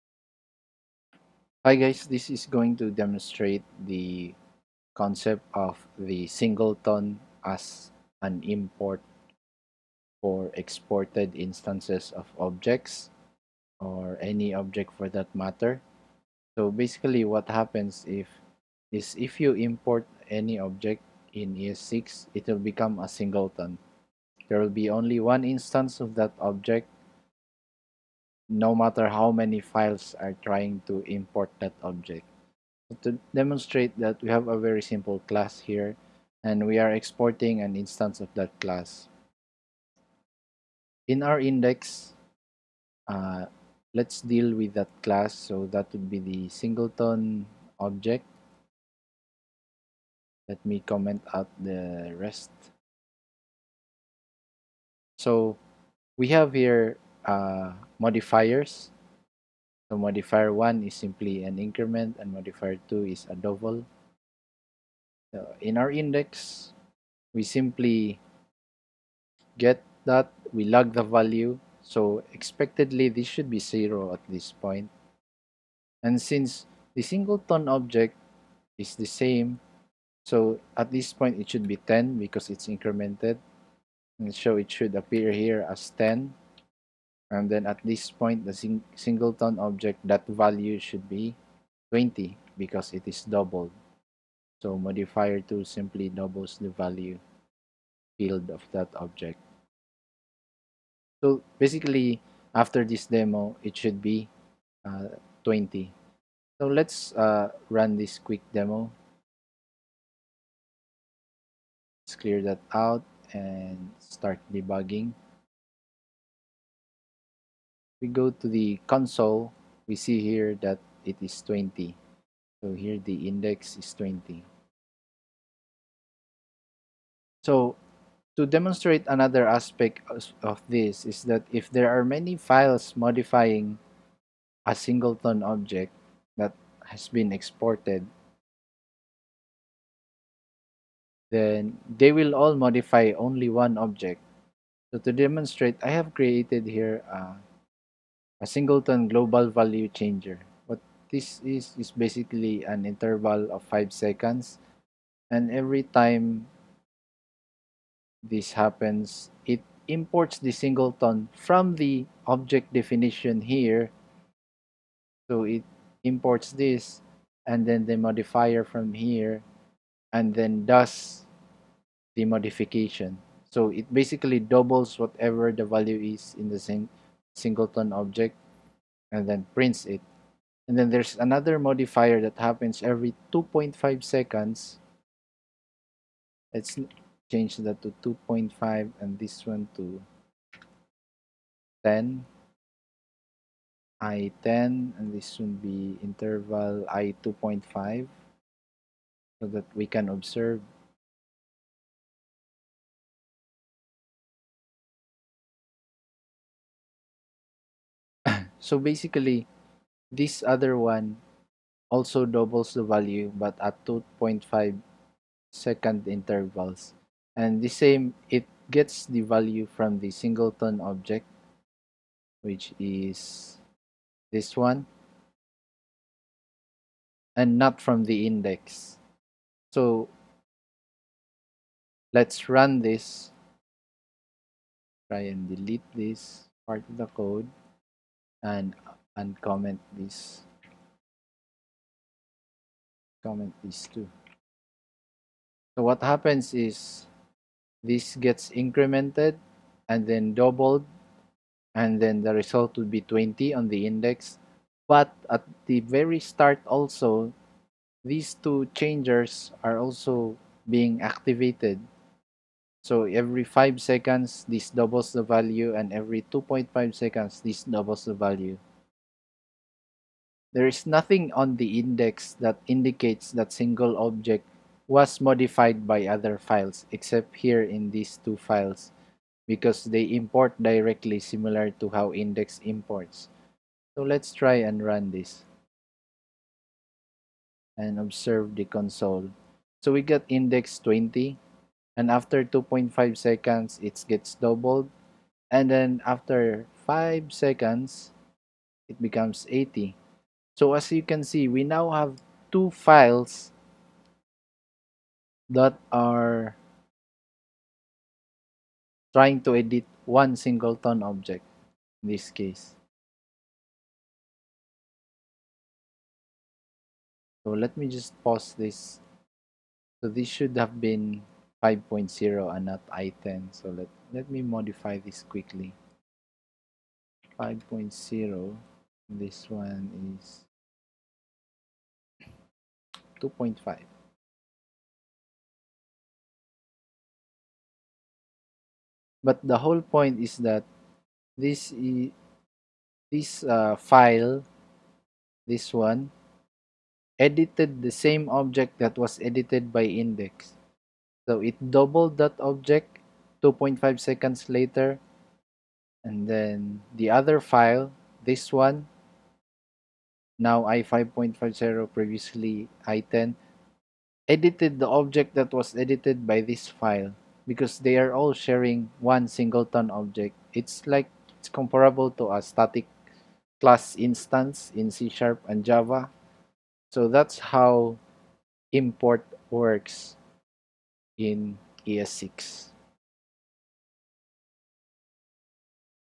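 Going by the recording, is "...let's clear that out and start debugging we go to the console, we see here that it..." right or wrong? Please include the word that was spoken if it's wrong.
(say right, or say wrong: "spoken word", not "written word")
right.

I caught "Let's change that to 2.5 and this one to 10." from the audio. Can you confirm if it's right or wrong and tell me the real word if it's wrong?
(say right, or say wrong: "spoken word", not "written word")
right.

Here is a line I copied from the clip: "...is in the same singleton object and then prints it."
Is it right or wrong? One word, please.
right.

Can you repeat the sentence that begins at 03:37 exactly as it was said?
And the same, it gets the value from the singleton object, which is this one, and not from the index.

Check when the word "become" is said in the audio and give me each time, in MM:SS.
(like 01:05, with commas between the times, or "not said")
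00:22, 04:59.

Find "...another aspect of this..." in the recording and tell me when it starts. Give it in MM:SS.
02:09.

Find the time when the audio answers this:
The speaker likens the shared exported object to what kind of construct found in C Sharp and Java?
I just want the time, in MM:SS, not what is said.
06:12.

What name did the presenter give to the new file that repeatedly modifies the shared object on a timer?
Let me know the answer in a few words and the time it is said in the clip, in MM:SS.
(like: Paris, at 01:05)
Singleton global value changer, at 02:28.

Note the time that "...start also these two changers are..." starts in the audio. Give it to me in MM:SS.
04:16.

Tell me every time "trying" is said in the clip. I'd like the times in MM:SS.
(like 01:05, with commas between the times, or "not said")
00:30, 05:09.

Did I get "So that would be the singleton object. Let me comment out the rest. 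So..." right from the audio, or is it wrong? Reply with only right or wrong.
right.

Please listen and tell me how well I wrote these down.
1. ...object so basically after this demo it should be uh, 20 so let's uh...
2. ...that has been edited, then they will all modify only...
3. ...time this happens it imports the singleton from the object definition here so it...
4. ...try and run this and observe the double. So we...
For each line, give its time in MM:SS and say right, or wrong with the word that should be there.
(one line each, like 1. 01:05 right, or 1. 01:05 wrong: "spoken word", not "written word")
1. 01:38 right
2. 02:16 wrong: "exported", not "edited"
3. 02:35 right
4. 04:44 wrong: "console", not "double".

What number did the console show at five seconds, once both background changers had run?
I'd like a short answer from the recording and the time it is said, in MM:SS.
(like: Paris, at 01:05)
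80, at 04:59.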